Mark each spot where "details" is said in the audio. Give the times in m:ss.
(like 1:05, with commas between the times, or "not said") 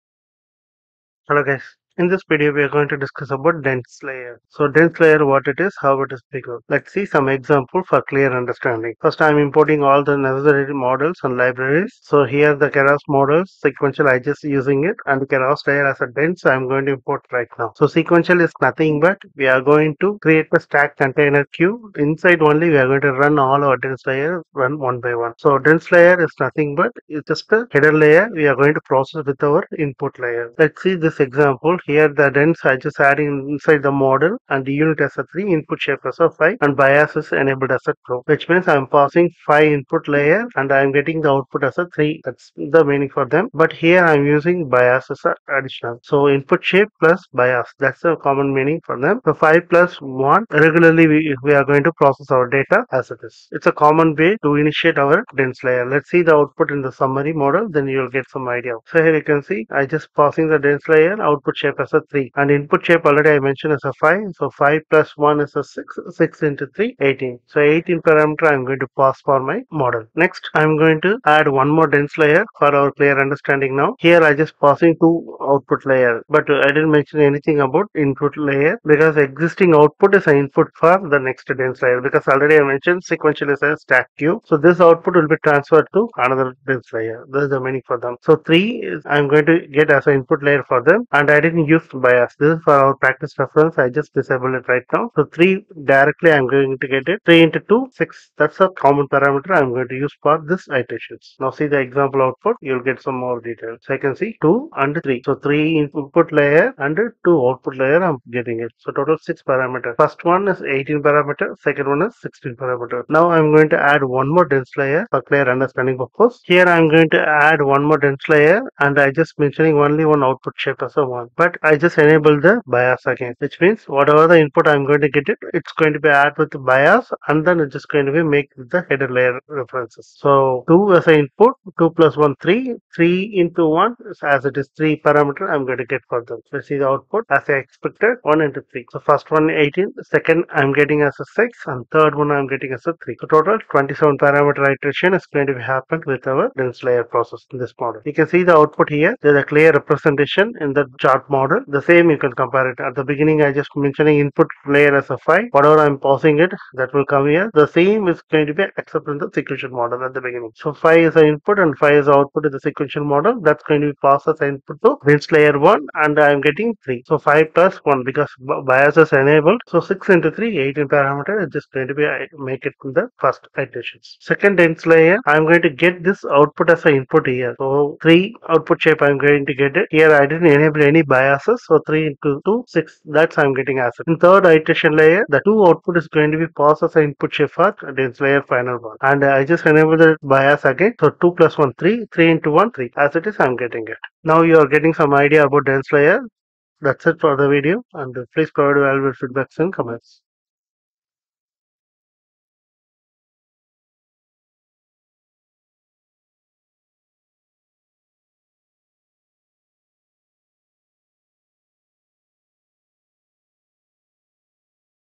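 1:43.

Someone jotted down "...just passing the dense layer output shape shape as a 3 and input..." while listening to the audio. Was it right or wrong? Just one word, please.
right.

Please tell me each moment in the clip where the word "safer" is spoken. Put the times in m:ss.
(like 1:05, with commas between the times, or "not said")
not said.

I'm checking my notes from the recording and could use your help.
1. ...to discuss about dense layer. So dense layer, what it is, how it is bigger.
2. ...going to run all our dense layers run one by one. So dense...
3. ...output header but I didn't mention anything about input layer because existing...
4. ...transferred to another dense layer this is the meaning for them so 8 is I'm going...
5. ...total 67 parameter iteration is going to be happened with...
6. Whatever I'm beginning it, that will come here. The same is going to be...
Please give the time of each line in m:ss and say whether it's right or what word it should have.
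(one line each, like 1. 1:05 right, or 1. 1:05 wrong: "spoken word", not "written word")
1. 0:02 right
2. 0:22 right
3. 1:15 wrong: "layer", not "header"
4. 1:25 wrong: "3", not "8"
5. 2:23 wrong: "27", not "67"
6. 2:35 wrong: "passing", not "beginning".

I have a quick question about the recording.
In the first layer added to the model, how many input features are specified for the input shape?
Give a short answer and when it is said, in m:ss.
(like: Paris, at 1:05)
5, at 0:35.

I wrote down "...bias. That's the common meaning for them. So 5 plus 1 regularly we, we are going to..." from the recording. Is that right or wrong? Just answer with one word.
right.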